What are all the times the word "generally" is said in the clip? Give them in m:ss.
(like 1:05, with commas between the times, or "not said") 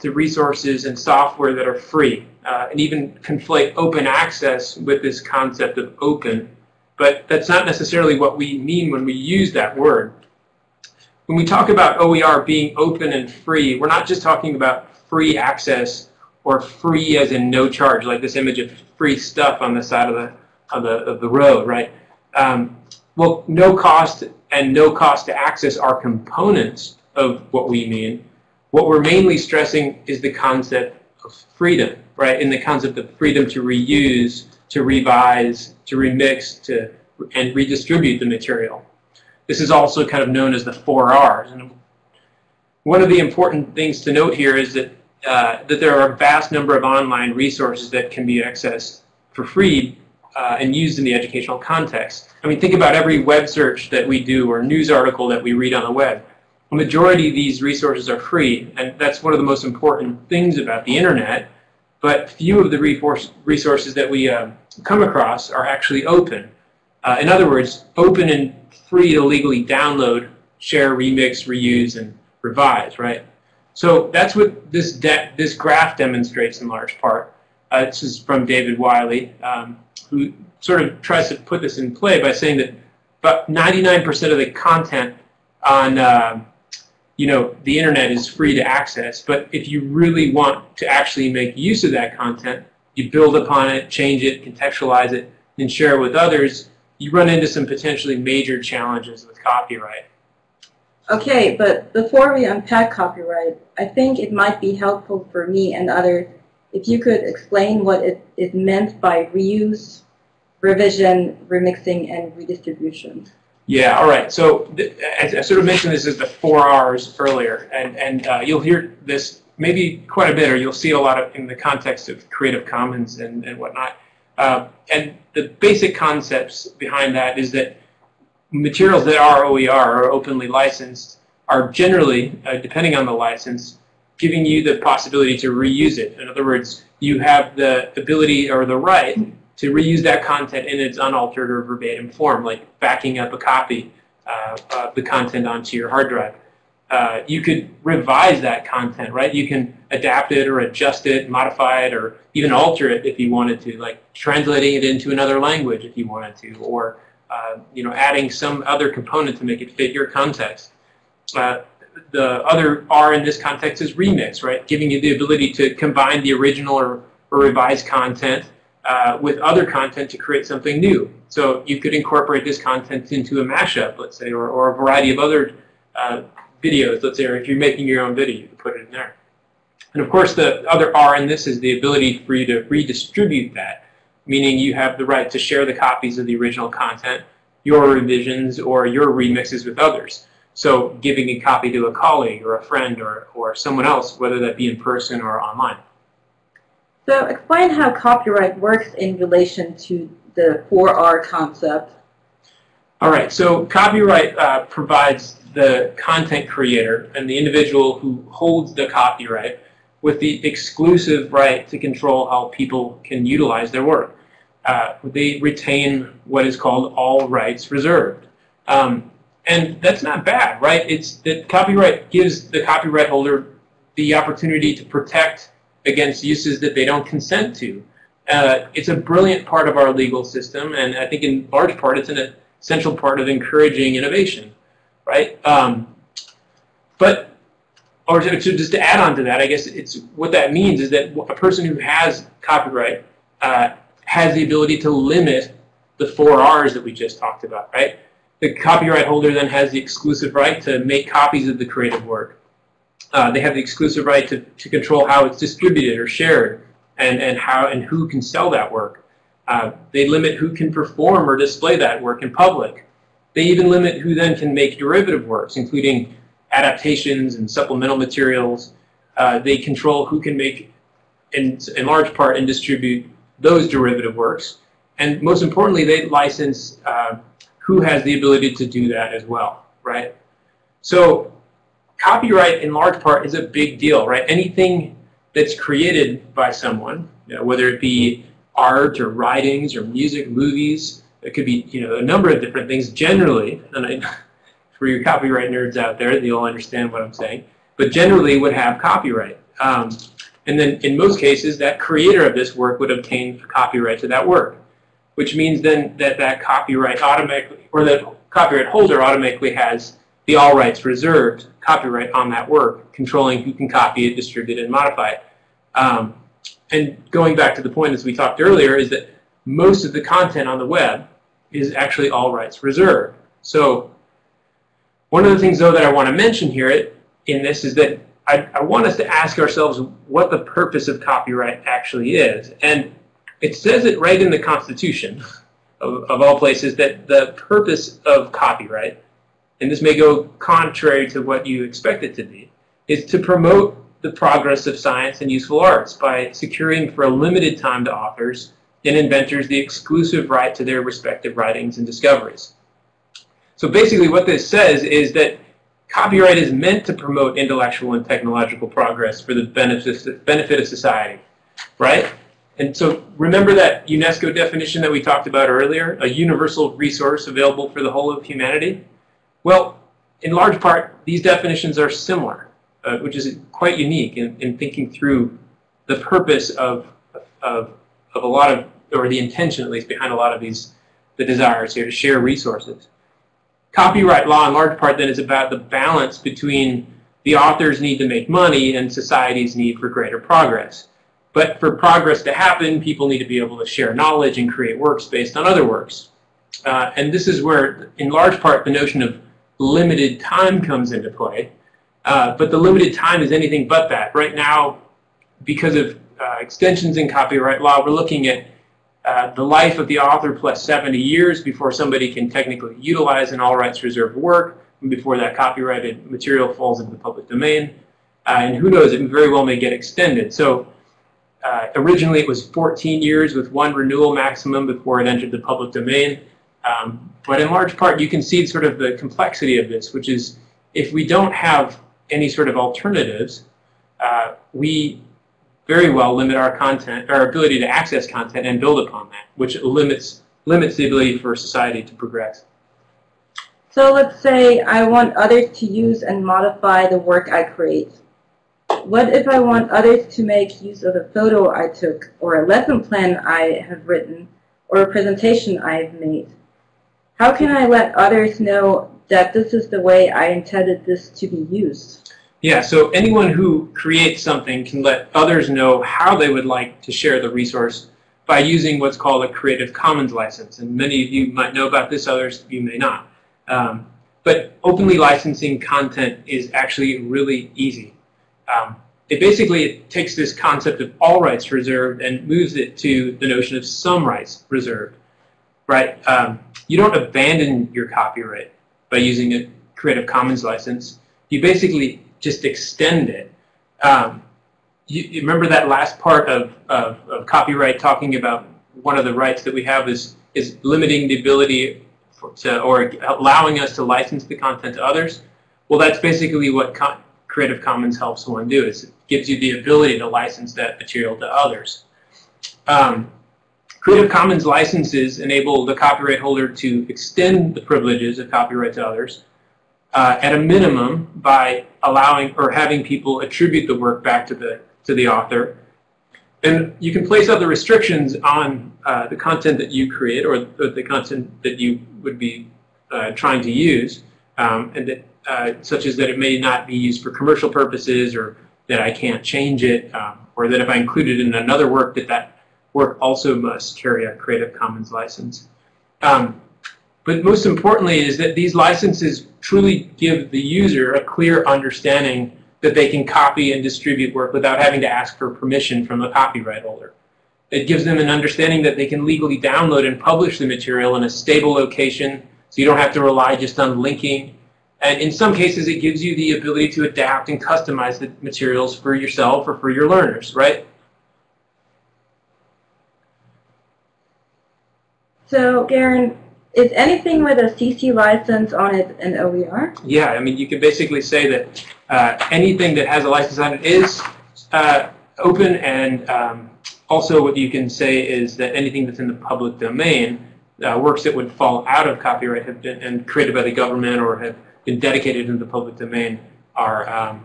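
2:11, 4:52, 4:57.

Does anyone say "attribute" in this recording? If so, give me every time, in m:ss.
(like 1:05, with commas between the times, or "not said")
8:43.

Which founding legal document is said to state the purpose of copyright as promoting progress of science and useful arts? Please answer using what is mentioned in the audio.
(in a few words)
the Constitution.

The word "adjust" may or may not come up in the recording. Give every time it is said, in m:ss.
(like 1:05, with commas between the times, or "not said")
2:30.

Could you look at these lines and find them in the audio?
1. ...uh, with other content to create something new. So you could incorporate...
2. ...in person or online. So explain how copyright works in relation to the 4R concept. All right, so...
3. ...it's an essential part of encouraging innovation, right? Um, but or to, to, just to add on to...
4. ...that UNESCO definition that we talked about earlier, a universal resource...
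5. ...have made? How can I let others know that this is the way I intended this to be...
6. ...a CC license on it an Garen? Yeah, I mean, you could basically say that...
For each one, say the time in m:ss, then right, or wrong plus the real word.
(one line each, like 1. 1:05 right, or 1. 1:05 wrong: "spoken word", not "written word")
1. 2:48 right
2. 3:14 right
3. 3:51 right
4. 6:03 right
5. 7:35 right
6. 9:37 wrong: "OER", not "Garen".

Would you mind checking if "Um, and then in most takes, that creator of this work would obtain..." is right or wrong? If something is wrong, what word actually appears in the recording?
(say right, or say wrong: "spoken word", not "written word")
wrong: "cases", not "takes".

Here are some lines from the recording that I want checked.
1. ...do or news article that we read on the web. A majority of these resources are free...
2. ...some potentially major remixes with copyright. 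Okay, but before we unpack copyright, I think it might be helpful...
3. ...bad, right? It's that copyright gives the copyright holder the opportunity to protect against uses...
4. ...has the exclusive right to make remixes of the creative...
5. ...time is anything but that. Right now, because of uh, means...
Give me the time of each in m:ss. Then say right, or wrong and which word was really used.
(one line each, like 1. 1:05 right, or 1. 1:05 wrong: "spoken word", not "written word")
1. 0:54 right
2. 1:37 wrong: "challenges", not "remixes"
3. 3:40 right
4. 4:09 wrong: "copies", not "remixes"
5. 6:42 wrong: "extensions", not "means".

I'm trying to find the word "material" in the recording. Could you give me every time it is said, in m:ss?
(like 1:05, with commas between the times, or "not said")
0:38, 2:08, 4:27, 6:56, 8:30, 9:20, 9:28.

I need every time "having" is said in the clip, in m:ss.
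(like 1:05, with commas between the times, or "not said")
8:42, 9:14.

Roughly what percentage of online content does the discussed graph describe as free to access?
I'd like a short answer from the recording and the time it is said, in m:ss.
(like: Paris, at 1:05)
99%, at 1:23.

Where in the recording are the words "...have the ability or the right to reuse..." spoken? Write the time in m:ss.
2:17.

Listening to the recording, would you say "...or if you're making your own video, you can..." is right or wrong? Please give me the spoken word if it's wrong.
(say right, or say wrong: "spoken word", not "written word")
right.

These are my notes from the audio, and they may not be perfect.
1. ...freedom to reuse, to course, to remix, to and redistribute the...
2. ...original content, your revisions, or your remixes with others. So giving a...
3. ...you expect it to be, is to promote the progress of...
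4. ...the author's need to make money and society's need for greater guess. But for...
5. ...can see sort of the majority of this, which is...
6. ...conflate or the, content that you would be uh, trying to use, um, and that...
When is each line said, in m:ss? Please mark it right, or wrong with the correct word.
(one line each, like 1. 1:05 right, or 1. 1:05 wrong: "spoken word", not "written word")
1. 0:33 wrong: "revise", not "course"
2. 3:06 right
3. 5:41 right
4. 6:27 wrong: "progress", not "guess"
5. 7:08 wrong: "complexity", not "majority"
6. 8:49 wrong: "create", not "conflate".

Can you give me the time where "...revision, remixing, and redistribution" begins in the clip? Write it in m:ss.
1:50.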